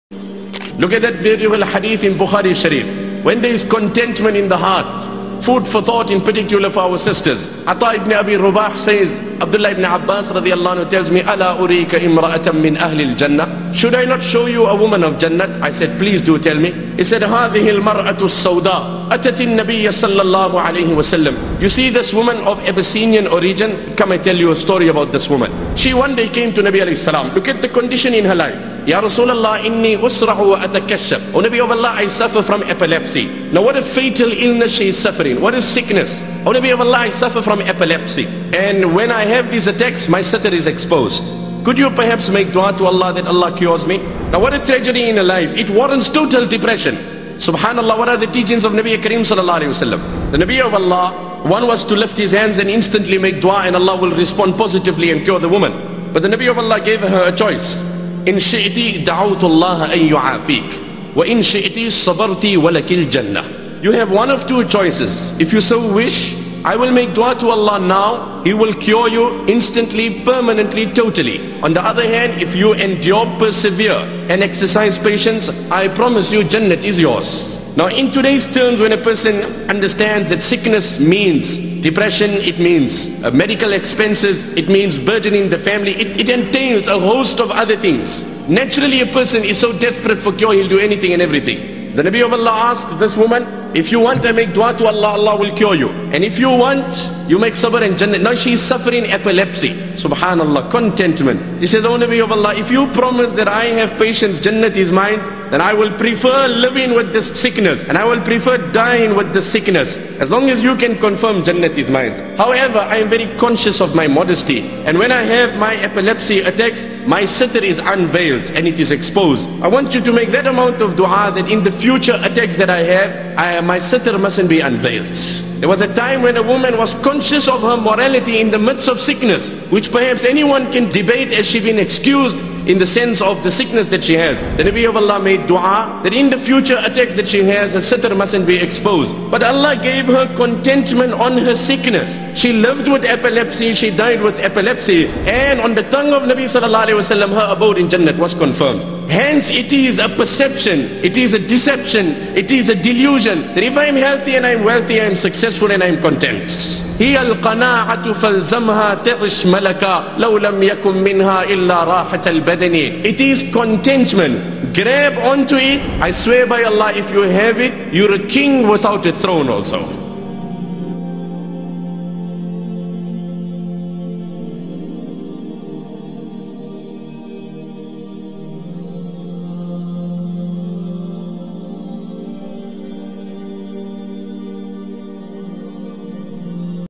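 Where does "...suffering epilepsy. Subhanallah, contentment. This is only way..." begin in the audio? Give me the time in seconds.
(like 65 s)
98 s.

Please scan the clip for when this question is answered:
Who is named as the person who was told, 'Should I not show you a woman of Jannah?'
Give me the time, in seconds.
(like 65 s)
7 s.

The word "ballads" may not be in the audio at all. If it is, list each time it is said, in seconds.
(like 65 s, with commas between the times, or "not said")
not said.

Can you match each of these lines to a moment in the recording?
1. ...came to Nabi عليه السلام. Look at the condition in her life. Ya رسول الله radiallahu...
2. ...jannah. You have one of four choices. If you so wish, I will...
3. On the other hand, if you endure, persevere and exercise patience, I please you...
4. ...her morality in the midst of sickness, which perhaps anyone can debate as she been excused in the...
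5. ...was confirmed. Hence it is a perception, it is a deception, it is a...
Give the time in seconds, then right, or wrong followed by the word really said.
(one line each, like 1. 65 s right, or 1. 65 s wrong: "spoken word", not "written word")
1. 26 s wrong: "usrahu", not "radiallahu"
2. 63 s wrong: "two", not "four"
3. 71 s wrong: "promise", not "please"
4. 127 s right
5. 148 s right.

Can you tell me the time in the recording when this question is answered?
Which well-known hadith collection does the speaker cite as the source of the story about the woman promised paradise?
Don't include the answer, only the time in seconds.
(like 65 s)
2 s.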